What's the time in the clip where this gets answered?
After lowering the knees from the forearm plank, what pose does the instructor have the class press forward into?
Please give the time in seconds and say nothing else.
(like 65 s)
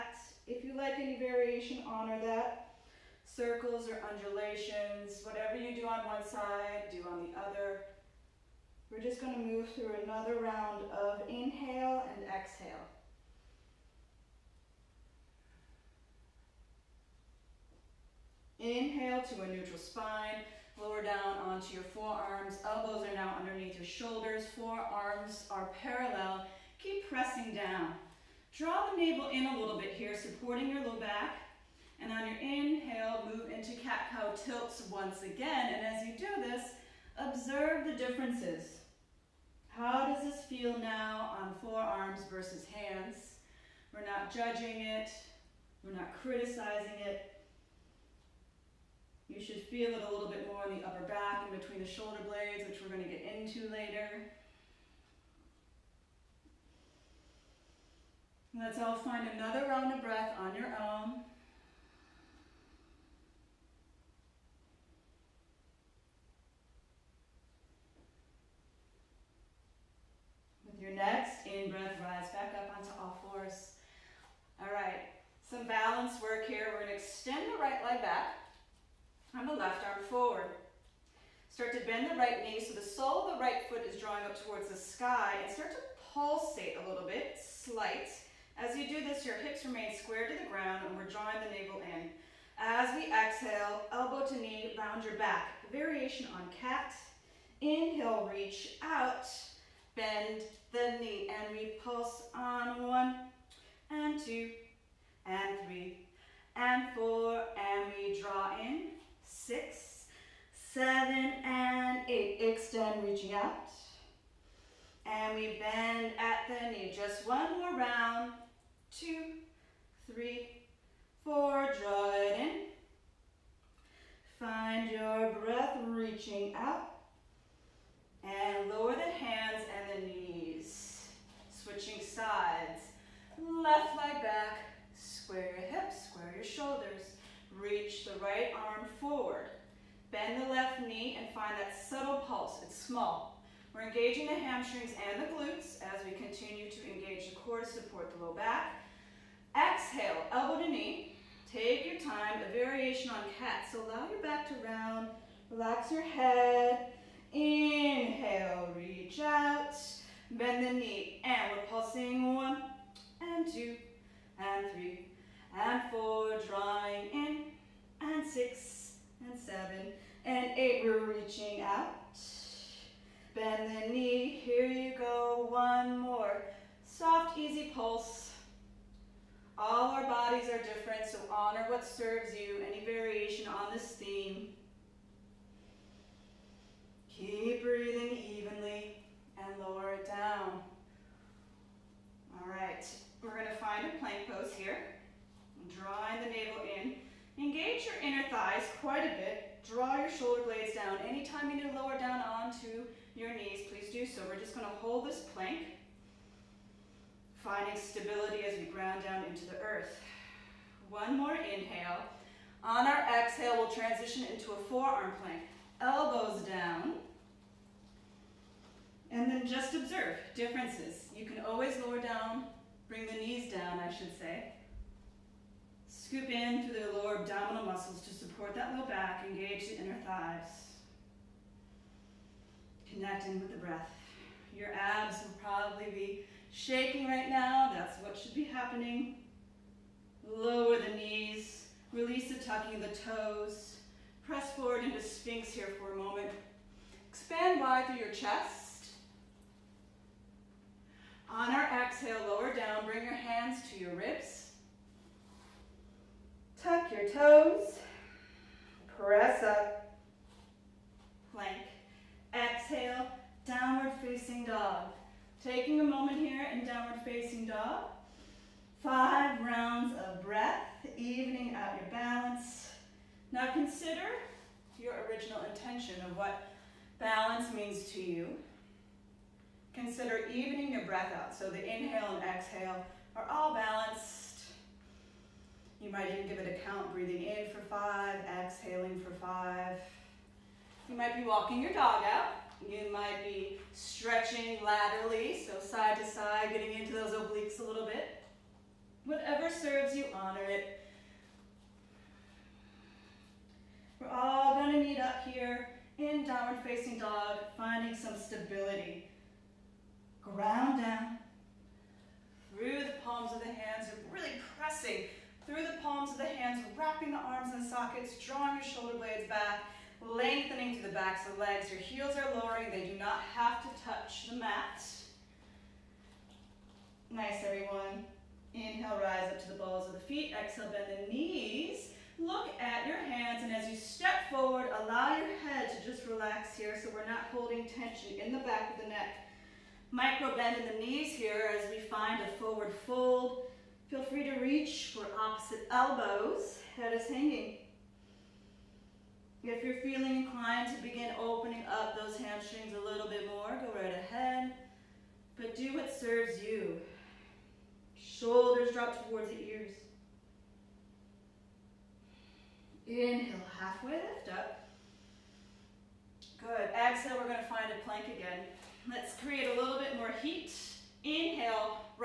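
245 s.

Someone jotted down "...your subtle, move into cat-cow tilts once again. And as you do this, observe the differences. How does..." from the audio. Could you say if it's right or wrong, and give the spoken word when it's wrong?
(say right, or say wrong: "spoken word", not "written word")
wrong: "inhale", not "subtle".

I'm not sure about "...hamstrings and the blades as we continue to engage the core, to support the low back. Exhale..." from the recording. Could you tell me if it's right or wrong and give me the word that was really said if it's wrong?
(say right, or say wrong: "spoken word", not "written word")
wrong: "glutes", not "blades".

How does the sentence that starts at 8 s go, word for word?
We're just going to move through another round of inhale and exhale.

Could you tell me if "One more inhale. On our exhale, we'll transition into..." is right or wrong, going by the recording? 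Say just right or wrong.
right.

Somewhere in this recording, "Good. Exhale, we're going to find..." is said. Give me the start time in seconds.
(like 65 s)
366 s.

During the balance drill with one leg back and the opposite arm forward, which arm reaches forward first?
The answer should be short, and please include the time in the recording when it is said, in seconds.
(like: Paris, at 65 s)
Left arm, at 79 s.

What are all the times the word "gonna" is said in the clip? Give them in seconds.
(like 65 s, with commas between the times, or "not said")
76 s, 193 s, 204 s, 304 s.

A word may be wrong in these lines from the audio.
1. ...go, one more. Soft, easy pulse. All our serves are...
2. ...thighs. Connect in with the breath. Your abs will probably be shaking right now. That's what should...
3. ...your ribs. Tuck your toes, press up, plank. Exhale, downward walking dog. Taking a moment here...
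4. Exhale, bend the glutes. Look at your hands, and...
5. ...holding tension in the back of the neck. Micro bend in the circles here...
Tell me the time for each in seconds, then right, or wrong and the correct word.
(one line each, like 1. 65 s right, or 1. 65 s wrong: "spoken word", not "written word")
1. 174 s wrong: "bodies", not "serves"
2. 230 s right
3. 253 s wrong: "facing", not "walking"
4. 330 s wrong: "knees", not "glutes"
5. 337 s wrong: "knees", not "circles".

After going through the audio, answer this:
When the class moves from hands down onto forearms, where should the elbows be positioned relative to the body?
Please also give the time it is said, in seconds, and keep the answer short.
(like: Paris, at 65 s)
Underneath your shoulders, at 23 s.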